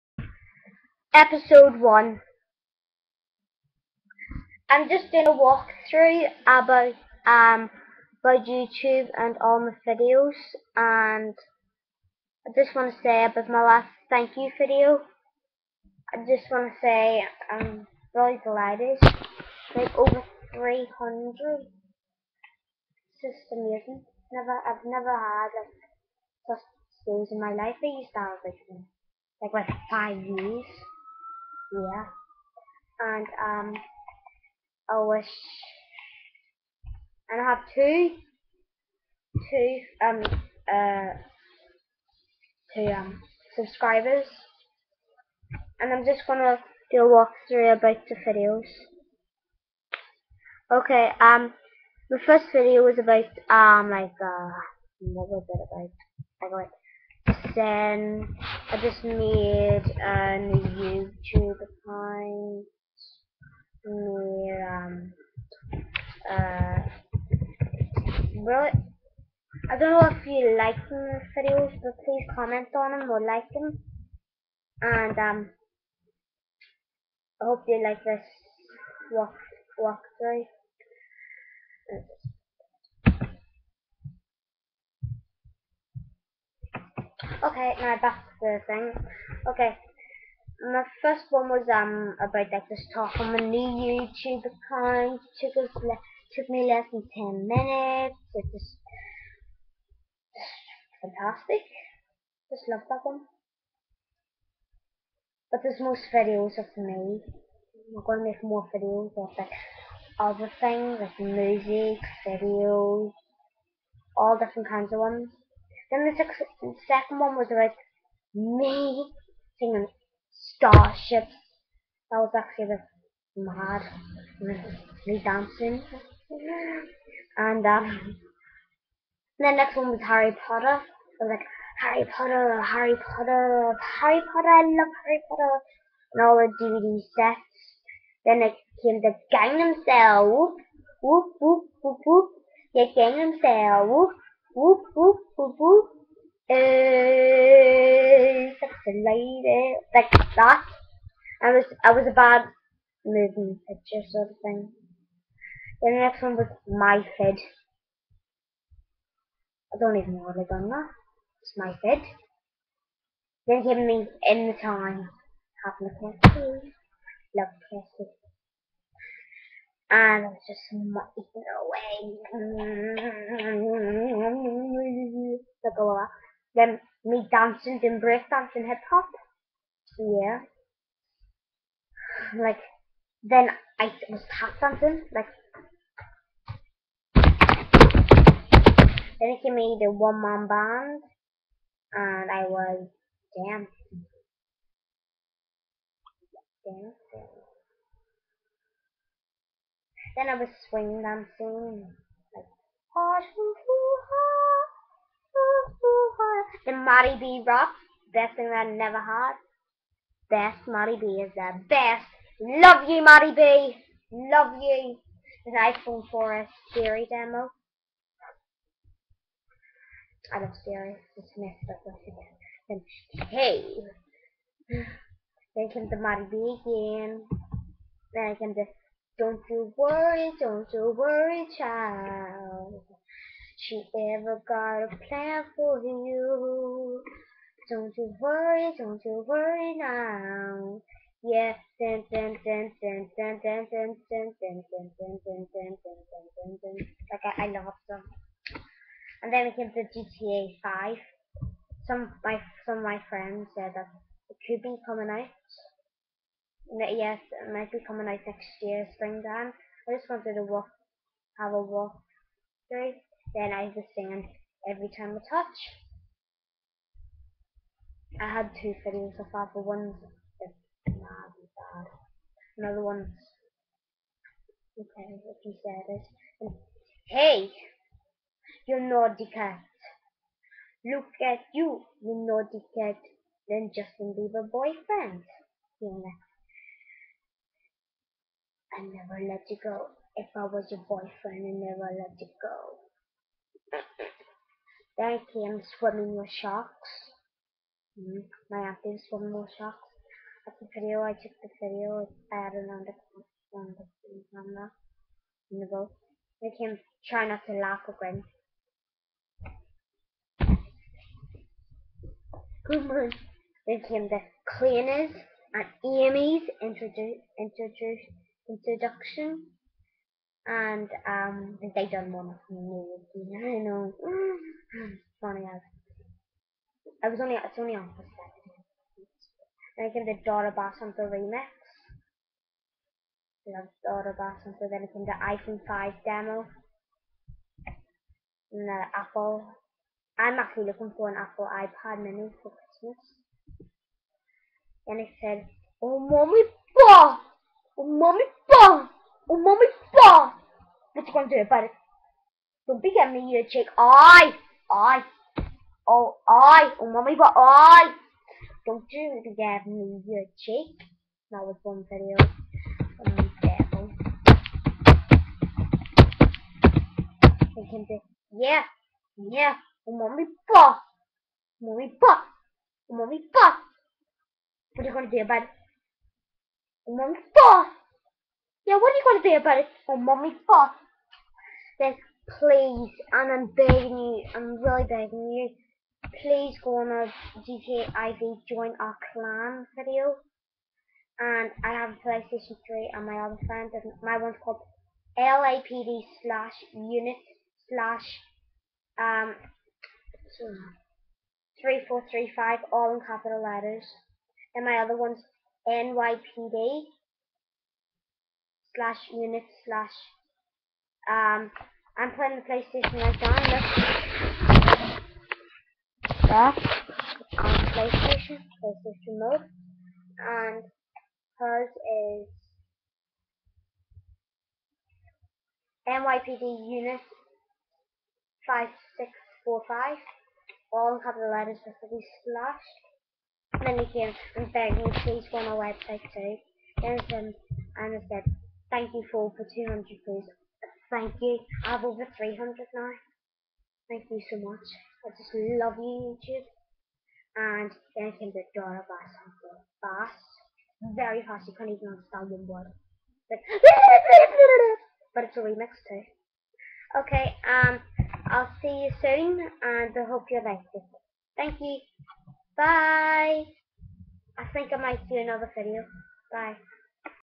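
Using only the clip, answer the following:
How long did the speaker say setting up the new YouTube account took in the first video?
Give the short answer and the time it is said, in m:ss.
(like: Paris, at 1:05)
less than 10 minutes, at 1:36.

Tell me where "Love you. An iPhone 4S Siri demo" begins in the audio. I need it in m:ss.
3:34.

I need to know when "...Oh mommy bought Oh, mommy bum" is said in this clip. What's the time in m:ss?
5:45.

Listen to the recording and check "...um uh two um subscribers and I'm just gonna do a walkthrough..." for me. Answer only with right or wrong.
right.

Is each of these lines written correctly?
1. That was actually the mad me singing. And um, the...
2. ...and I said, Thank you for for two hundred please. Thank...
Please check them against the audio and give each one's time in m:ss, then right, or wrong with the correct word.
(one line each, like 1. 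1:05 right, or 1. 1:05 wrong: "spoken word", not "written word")
1. 2:02 wrong: "dancing", not "singing"
2. 7:17 right.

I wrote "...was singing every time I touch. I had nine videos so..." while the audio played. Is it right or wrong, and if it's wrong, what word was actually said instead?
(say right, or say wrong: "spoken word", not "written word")
wrong: "two", not "nine".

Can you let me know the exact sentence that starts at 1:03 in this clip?
Need um uh really I don't know if you like these videos, but please comment on them or like them.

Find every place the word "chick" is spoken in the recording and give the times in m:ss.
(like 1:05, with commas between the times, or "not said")
5:53, 6:00.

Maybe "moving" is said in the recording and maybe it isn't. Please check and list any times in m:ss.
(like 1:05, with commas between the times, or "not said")
2:33.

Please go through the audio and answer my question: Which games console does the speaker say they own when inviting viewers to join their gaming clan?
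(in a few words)
PlayStation 3.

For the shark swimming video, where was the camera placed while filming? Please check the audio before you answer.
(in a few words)
in the boat.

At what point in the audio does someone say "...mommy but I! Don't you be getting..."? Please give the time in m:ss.
5:56.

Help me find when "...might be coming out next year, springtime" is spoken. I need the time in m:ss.
4:17.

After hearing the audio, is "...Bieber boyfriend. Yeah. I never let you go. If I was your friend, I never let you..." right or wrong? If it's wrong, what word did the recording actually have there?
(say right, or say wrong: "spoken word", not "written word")
wrong: "boyfriend", not "friend".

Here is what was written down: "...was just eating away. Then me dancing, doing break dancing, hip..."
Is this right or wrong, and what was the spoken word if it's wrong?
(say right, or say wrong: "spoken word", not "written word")
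right.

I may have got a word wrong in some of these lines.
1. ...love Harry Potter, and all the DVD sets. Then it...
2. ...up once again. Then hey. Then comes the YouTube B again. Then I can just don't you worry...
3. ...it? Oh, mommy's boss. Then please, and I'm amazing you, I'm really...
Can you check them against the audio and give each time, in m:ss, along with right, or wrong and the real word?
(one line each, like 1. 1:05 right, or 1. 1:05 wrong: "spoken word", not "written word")
1. 2:14 right
2. 3:41 wrong: "Marty", not "YouTube"
3. 6:19 wrong: "begging", not "amazing".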